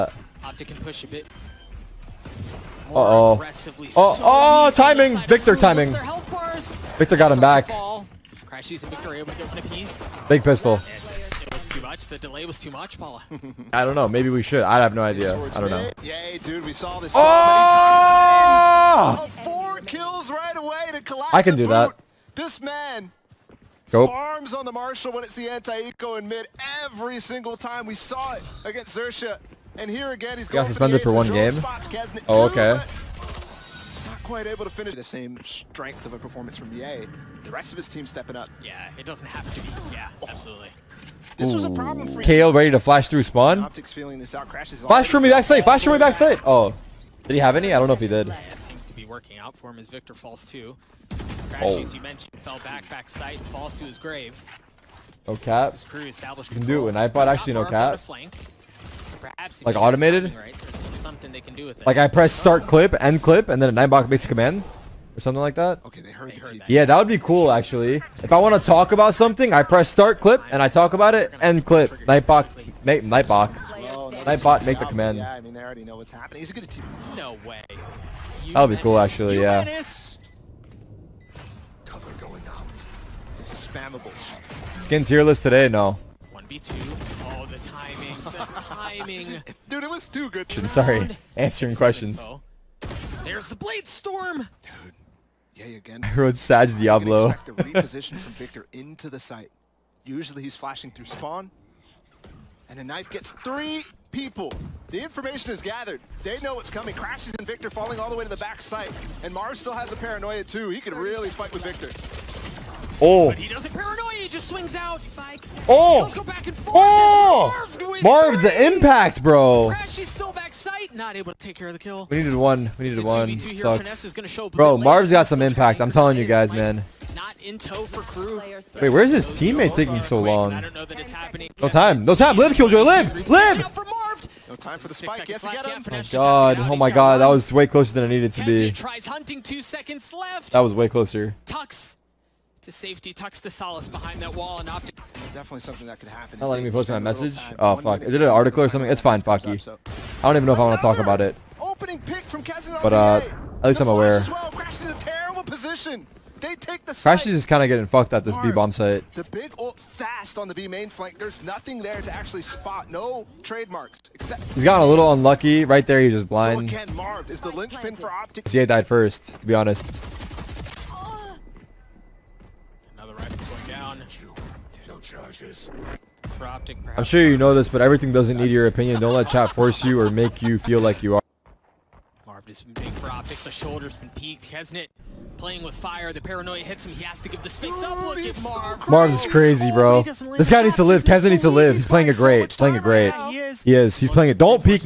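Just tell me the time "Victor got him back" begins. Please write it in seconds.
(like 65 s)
6 s.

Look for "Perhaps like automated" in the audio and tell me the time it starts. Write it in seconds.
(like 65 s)
59 s.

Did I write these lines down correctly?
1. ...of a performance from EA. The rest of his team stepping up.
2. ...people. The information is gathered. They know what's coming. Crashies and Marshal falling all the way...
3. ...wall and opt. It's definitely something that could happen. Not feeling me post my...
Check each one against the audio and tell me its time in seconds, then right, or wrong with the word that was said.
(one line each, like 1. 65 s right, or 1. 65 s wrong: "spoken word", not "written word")
1. 36 s right
2. 104 s wrong: "Victor", not "Marshal"
3. 144 s wrong: "letting", not "feeling".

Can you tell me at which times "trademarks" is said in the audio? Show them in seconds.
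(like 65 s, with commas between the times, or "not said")
163 s.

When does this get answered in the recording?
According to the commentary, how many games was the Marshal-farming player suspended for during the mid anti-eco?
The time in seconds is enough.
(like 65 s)
31 s.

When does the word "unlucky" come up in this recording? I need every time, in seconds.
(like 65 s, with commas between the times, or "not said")
165 s.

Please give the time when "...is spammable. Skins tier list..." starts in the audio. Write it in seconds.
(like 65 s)
83 s.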